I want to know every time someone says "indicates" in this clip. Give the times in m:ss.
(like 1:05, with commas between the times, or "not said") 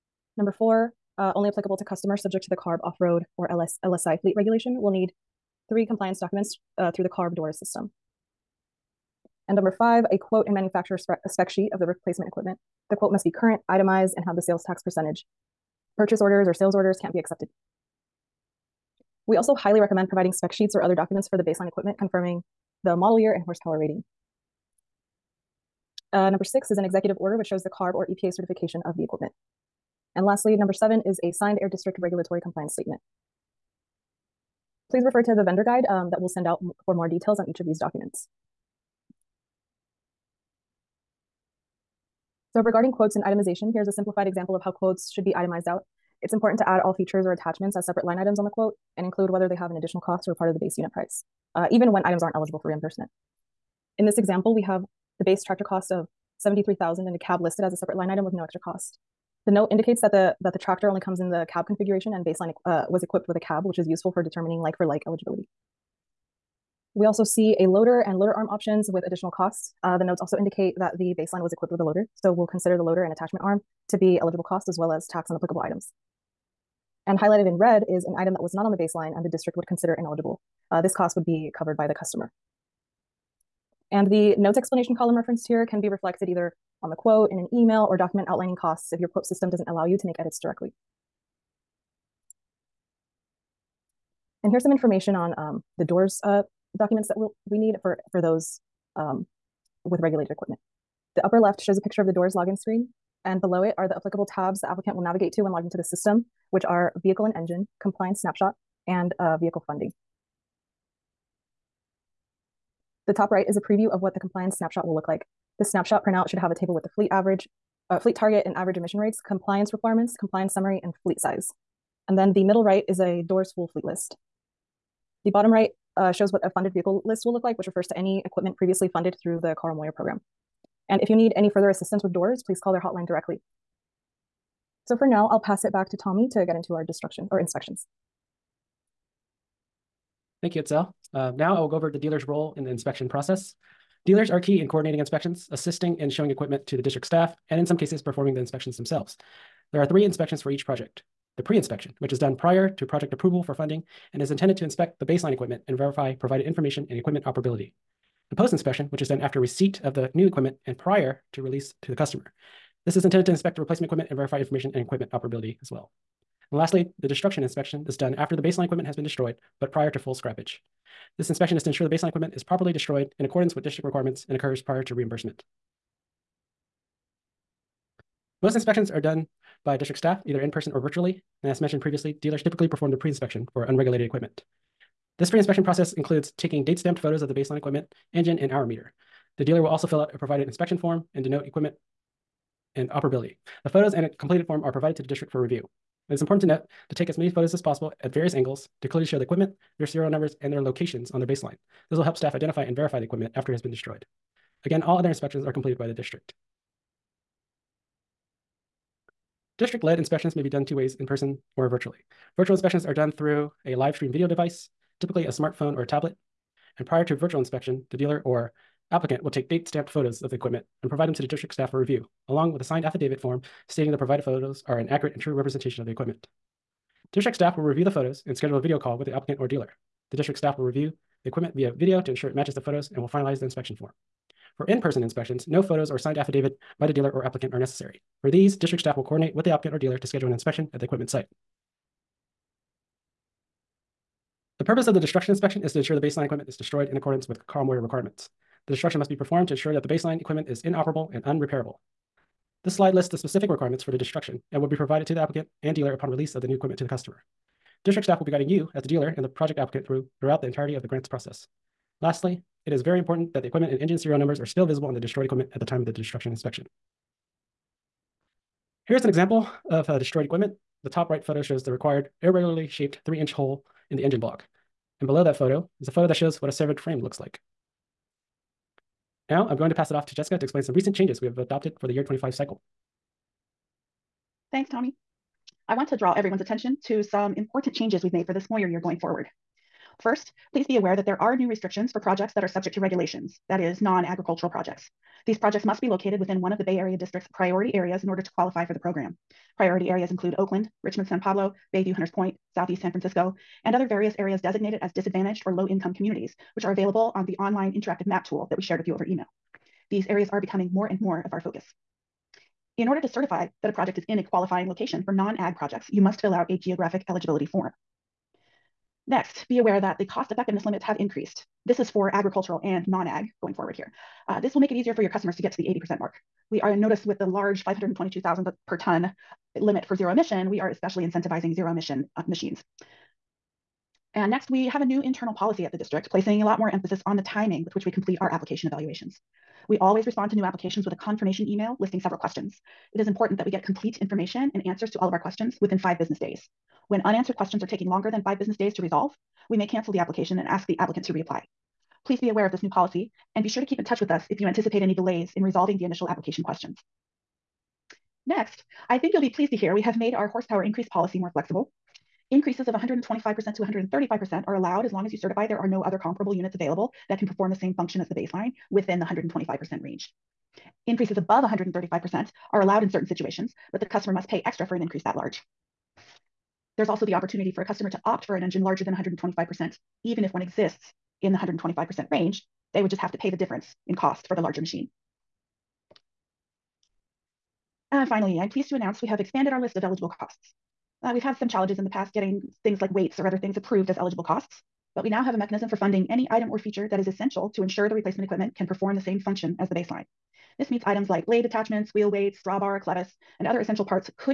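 0:59, 1:10.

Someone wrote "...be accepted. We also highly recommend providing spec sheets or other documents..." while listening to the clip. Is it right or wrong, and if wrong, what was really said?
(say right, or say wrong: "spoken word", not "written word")
right.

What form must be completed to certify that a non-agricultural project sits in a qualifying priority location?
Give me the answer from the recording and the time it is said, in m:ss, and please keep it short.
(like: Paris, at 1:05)
geographic eligibility form, at 5:16.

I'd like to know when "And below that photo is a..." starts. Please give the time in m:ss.
4:35.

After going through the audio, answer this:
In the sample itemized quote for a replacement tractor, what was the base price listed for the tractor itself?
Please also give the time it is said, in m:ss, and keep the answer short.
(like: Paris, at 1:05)
73,000, at 0:56.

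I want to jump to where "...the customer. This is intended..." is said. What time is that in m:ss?
2:41.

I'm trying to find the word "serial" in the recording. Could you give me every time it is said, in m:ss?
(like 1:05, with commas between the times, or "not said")
3:19, 4:23.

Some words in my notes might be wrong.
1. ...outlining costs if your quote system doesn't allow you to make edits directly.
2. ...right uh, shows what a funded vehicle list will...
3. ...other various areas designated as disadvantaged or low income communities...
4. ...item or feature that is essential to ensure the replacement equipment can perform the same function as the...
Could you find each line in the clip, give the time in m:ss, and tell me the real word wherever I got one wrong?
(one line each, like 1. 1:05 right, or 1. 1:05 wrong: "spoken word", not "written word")
1. 1:28 right
2. 2:05 right
3. 5:03 right
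4. 6:36 right.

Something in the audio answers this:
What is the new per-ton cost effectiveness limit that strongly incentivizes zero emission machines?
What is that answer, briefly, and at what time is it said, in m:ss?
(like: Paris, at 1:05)
522,000, at 5:27.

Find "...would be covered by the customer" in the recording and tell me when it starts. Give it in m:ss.
1:21.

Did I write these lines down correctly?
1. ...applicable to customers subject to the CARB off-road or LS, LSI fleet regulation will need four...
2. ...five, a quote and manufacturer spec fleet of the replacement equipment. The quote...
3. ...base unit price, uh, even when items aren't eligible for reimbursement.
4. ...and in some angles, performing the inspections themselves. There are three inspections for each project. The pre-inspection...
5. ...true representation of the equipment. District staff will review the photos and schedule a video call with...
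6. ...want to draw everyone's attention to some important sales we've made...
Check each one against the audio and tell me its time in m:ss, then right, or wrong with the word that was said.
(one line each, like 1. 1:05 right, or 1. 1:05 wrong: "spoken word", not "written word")
1. 0:01 wrong: "three", not "four"
2. 0:09 wrong: "sheet", not "fleet"
3. 0:50 right
4. 2:27 wrong: "cases", not "angles"
5. 3:45 right
6. 4:45 wrong: "changes", not "sales".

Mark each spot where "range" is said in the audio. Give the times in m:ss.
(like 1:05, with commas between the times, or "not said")
6:09, 6:22.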